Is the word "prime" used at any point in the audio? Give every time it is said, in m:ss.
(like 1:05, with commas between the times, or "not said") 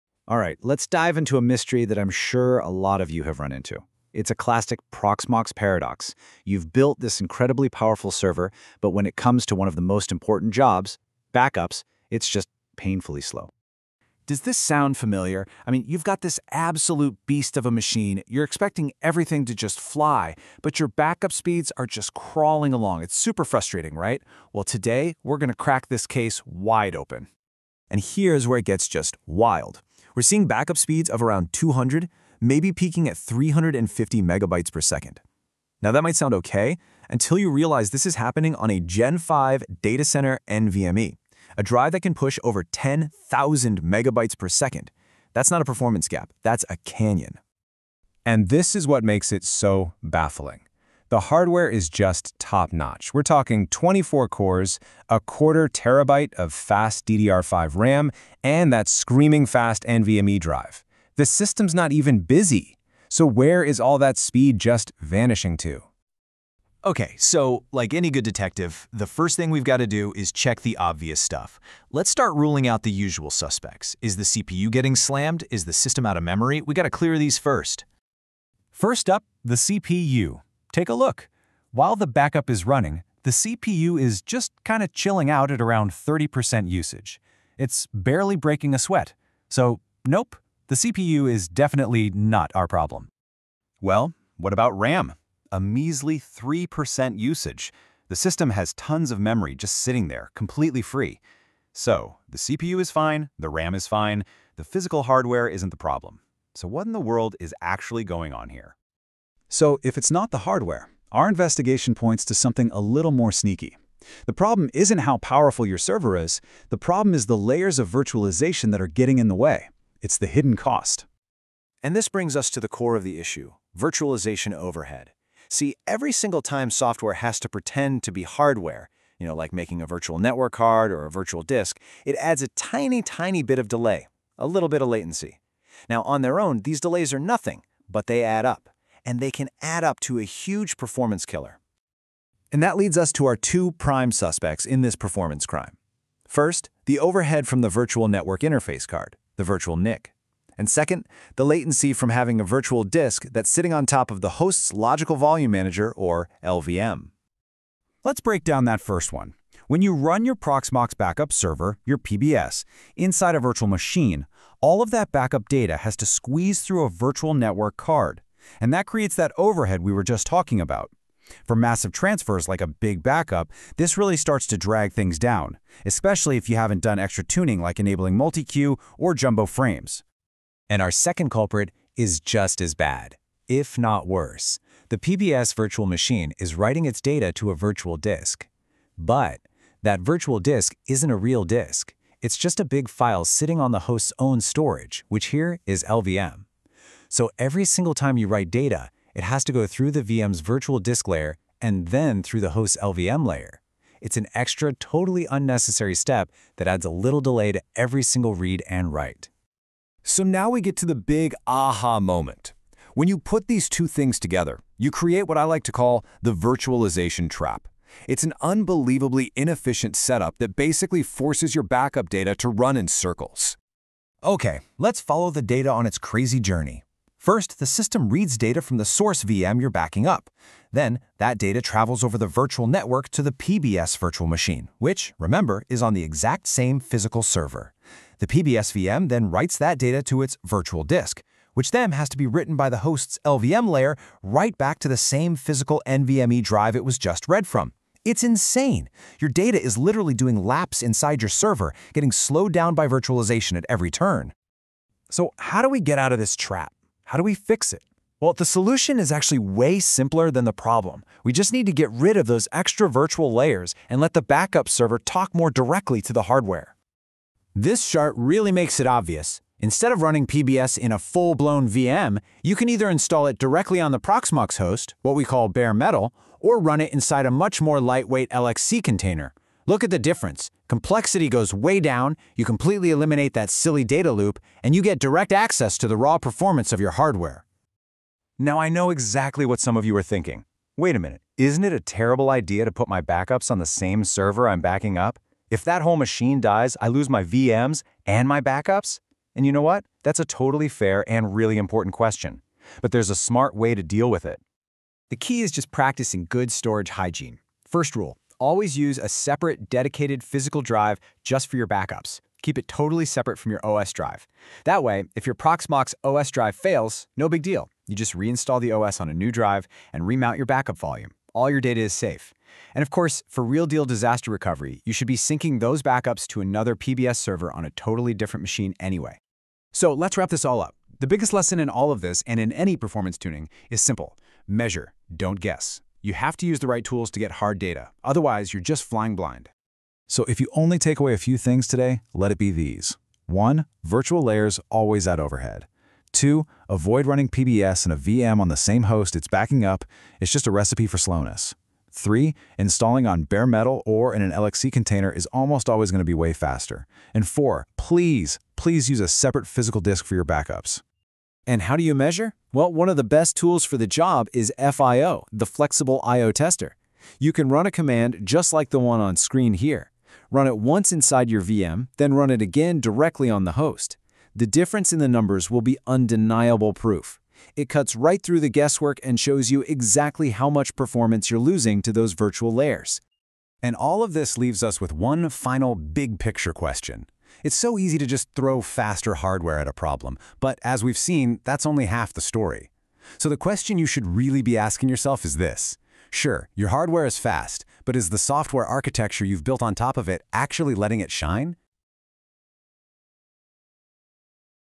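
2:23.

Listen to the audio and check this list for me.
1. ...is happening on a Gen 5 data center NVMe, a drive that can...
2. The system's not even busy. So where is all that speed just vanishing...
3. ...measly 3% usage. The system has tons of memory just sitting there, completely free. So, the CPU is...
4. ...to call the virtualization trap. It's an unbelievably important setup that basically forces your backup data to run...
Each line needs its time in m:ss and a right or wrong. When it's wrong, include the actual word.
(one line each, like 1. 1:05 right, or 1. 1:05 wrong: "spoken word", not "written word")
1. 0:38 right
2. 1:01 right
3. 1:35 right
4. 3:35 wrong: "inefficient", not "important".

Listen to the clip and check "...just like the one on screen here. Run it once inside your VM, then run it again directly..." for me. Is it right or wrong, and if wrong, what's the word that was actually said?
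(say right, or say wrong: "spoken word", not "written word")
right.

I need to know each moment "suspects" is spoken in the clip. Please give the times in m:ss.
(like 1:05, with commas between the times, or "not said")
1:13, 2:24.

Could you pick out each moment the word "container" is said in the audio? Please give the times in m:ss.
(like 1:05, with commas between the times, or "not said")
4:38, 5:54.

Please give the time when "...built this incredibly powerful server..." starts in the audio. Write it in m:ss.
0:06.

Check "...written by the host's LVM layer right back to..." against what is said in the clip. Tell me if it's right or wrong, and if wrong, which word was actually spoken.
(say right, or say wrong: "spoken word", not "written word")
right.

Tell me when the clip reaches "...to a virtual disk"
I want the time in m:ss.
3:07.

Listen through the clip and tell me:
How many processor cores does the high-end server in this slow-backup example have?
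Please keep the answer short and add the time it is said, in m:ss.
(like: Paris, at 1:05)
24, at 0:53.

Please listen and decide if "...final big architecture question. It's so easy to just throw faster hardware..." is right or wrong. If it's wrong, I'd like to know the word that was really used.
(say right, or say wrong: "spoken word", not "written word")
wrong: "picture", not "architecture".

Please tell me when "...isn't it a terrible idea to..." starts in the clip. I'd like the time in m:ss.
4:51.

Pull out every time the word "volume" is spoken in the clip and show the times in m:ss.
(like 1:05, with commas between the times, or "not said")
2:35, 5:20.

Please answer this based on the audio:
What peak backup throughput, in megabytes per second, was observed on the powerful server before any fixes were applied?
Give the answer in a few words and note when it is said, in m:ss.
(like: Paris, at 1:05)
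350, at 0:33.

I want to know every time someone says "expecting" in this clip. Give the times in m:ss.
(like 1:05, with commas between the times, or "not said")
0:18.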